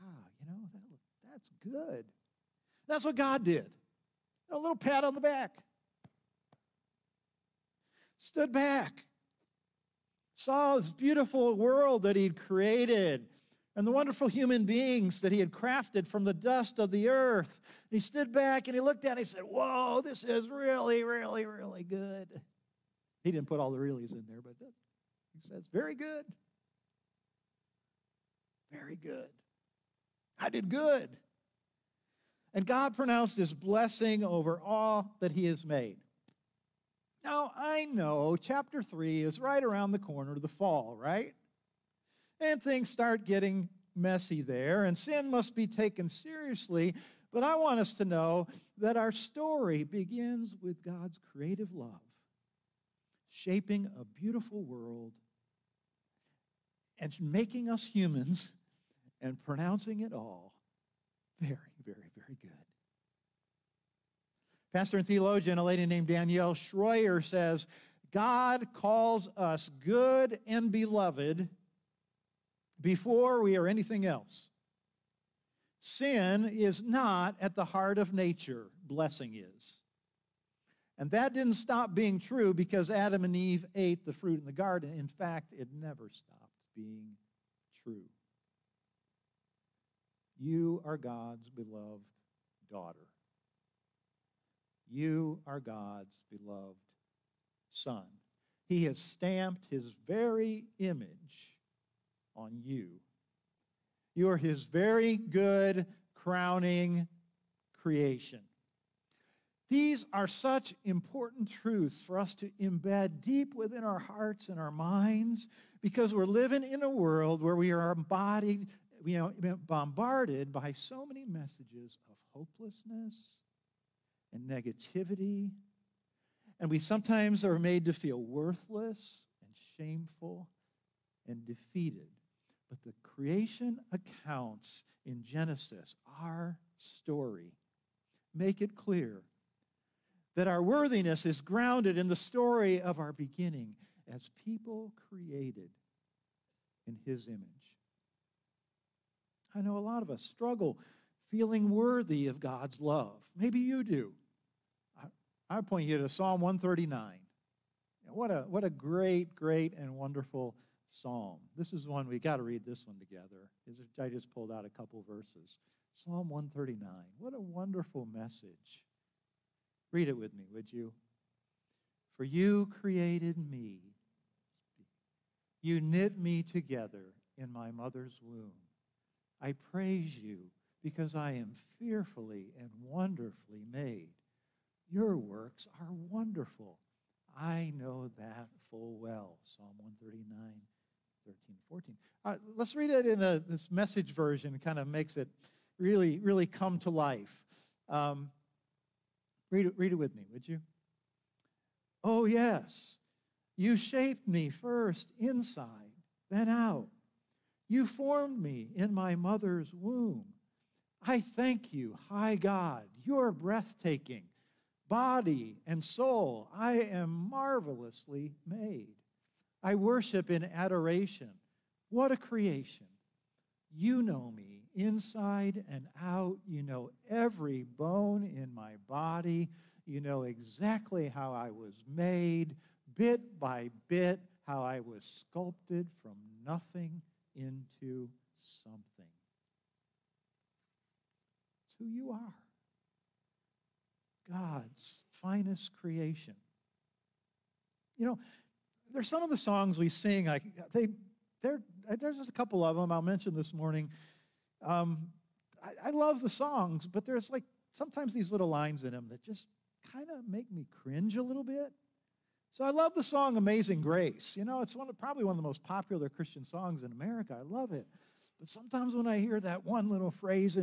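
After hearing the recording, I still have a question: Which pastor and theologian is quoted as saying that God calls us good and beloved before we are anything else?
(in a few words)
Danielle Shroyer.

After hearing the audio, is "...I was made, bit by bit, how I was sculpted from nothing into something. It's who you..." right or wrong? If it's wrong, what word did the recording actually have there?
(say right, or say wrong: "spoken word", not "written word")
right.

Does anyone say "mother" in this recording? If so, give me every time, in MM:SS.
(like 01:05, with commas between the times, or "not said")
02:57, 03:29.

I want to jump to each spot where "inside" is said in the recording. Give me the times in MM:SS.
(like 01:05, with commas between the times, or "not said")
03:25, 03:44.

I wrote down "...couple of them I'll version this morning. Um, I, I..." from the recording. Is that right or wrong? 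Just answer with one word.
wrong.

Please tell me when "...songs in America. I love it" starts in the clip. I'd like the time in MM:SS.
04:26.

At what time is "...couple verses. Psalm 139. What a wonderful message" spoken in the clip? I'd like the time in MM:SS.
02:44.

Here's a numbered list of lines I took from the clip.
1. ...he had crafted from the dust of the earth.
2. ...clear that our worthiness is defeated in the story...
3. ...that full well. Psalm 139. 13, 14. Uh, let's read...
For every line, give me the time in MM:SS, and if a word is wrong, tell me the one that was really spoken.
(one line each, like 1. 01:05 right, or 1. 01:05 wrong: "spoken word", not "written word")
1. 00:15 right
2. 02:18 wrong: "grounded", not "defeated"
3. 03:08 right.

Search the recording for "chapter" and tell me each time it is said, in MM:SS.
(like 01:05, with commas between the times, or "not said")
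00:38.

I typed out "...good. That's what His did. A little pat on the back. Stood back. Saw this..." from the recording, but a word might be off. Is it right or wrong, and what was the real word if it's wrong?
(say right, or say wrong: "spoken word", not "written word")
wrong: "God", not "His".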